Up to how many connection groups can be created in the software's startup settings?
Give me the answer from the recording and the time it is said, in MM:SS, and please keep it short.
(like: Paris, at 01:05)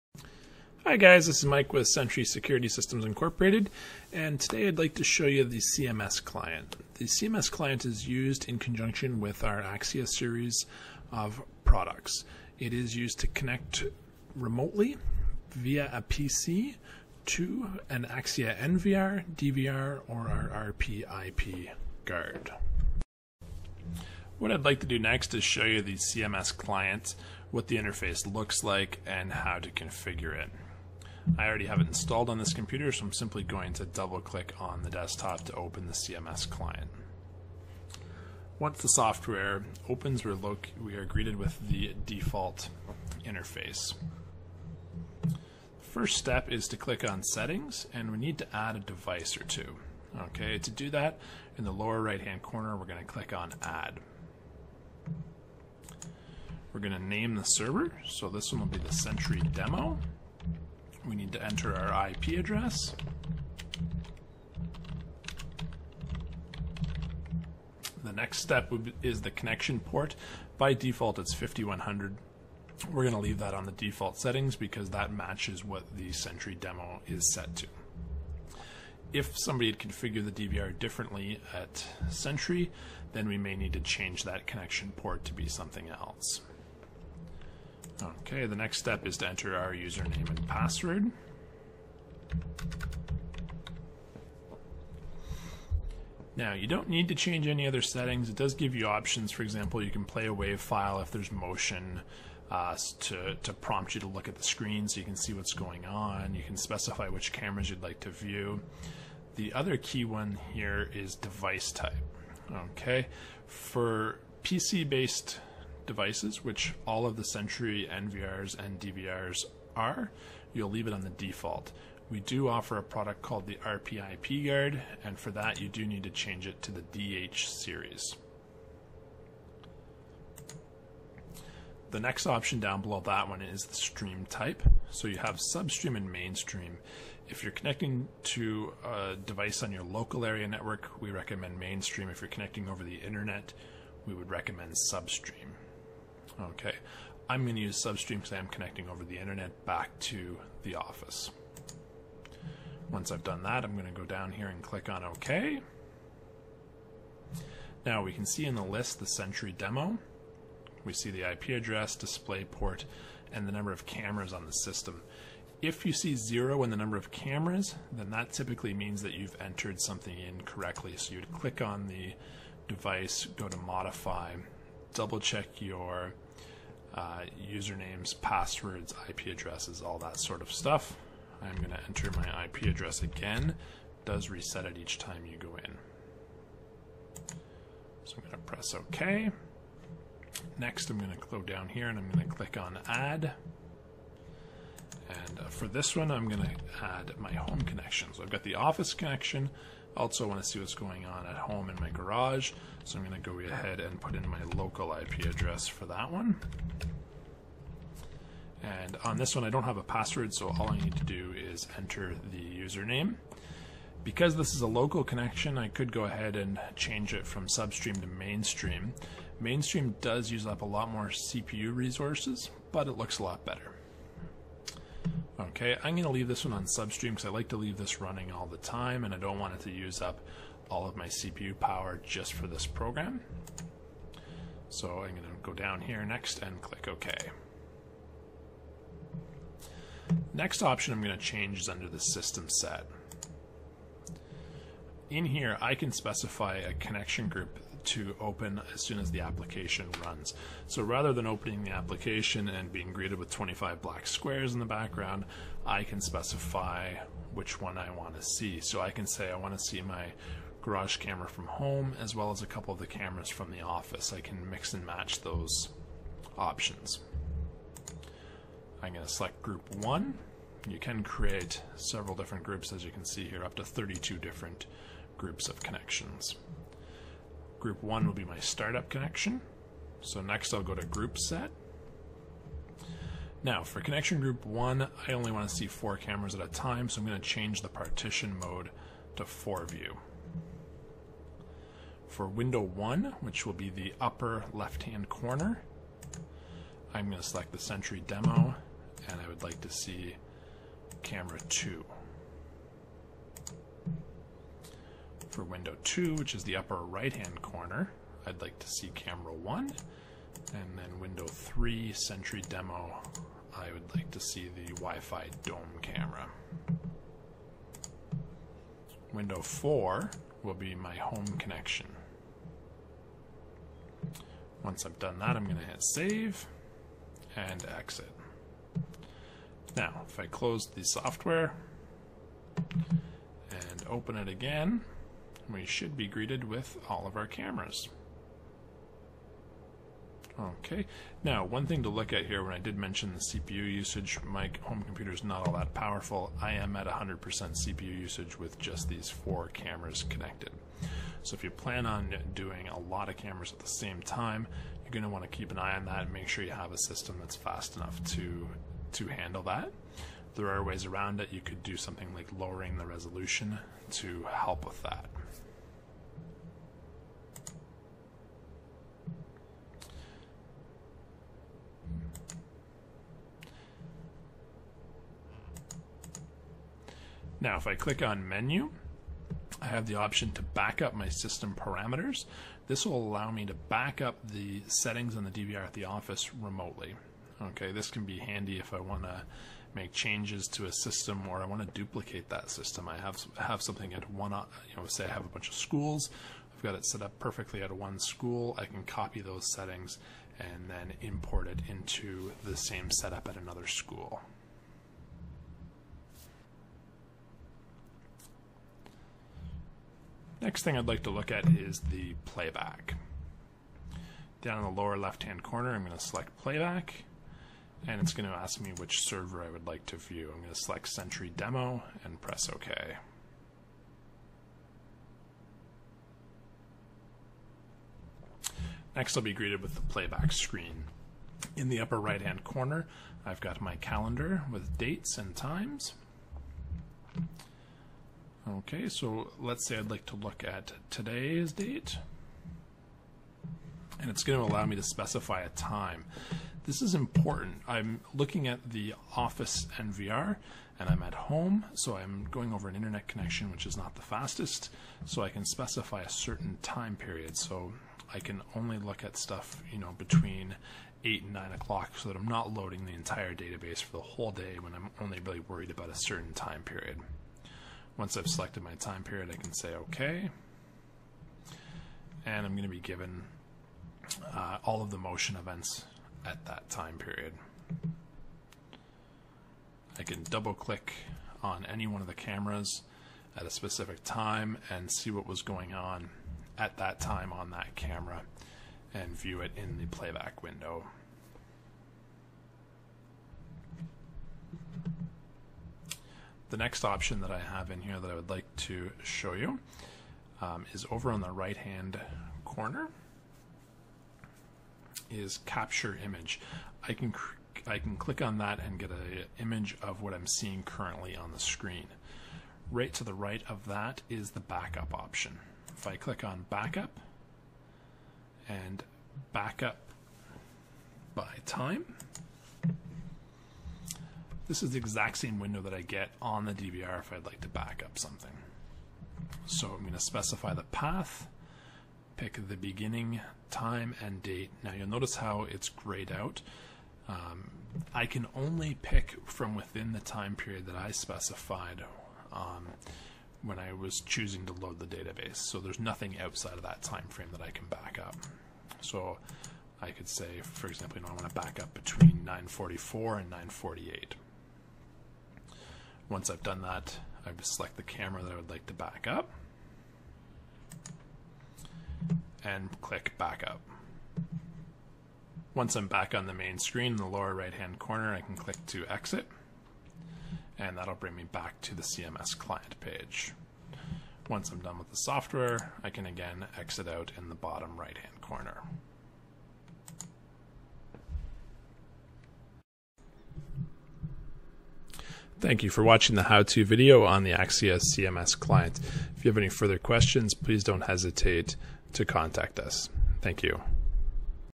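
32, at 04:33.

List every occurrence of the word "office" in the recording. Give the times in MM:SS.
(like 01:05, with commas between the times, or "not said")
02:30, 03:18, 04:23, 06:25, 07:29.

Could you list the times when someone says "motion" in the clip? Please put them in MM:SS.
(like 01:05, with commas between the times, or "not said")
01:41, 07:54.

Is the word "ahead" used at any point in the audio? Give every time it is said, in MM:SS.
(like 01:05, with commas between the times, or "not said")
03:23, 03:36.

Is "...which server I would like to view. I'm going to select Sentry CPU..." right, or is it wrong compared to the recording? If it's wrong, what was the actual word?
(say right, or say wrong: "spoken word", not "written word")
wrong: "Demo", not "CPU".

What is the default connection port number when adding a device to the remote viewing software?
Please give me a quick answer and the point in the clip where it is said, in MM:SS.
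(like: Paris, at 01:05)
5100, at 01:11.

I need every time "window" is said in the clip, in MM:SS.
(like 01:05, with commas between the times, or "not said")
04:52, 05:05, 05:10, 05:19, 08:10, 08:45.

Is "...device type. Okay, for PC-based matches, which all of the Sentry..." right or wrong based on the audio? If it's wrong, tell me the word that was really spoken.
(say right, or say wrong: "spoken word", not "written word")
wrong: "devices", not "matches".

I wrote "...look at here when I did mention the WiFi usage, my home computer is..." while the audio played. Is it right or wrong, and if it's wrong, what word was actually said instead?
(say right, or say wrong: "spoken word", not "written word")
wrong: "CPU", not "WiFi".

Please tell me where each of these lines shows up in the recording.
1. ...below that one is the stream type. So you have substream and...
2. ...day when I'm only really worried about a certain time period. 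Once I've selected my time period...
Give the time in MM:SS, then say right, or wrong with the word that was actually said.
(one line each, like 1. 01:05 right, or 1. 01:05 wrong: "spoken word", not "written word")
1. 02:12 right
2. 07:44 right.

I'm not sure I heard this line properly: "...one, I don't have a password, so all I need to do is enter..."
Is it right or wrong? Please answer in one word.
right.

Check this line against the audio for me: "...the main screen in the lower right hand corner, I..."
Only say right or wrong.
right.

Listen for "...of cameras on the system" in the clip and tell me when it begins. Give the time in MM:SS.
02:43.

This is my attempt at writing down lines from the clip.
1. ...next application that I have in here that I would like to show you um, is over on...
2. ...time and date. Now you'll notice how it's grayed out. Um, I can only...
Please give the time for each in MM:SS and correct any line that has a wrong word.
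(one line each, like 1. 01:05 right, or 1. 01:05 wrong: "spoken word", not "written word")
1. 08:16 wrong: "option", not "application"
2. 08:53 right.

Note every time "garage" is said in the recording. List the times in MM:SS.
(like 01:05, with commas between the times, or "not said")
03:21, 04:20.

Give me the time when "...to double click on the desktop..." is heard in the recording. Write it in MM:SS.
00:33.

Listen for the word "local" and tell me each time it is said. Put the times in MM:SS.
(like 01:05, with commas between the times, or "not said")
02:19, 03:24, 03:34.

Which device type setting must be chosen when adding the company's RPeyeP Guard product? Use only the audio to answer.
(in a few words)
DH series.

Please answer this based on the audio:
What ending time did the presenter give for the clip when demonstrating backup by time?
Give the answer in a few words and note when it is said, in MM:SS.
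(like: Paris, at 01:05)
948, at 09:13.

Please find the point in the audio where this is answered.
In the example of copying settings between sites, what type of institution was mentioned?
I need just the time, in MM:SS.
06:35.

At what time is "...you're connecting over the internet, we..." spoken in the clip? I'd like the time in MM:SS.
02:22.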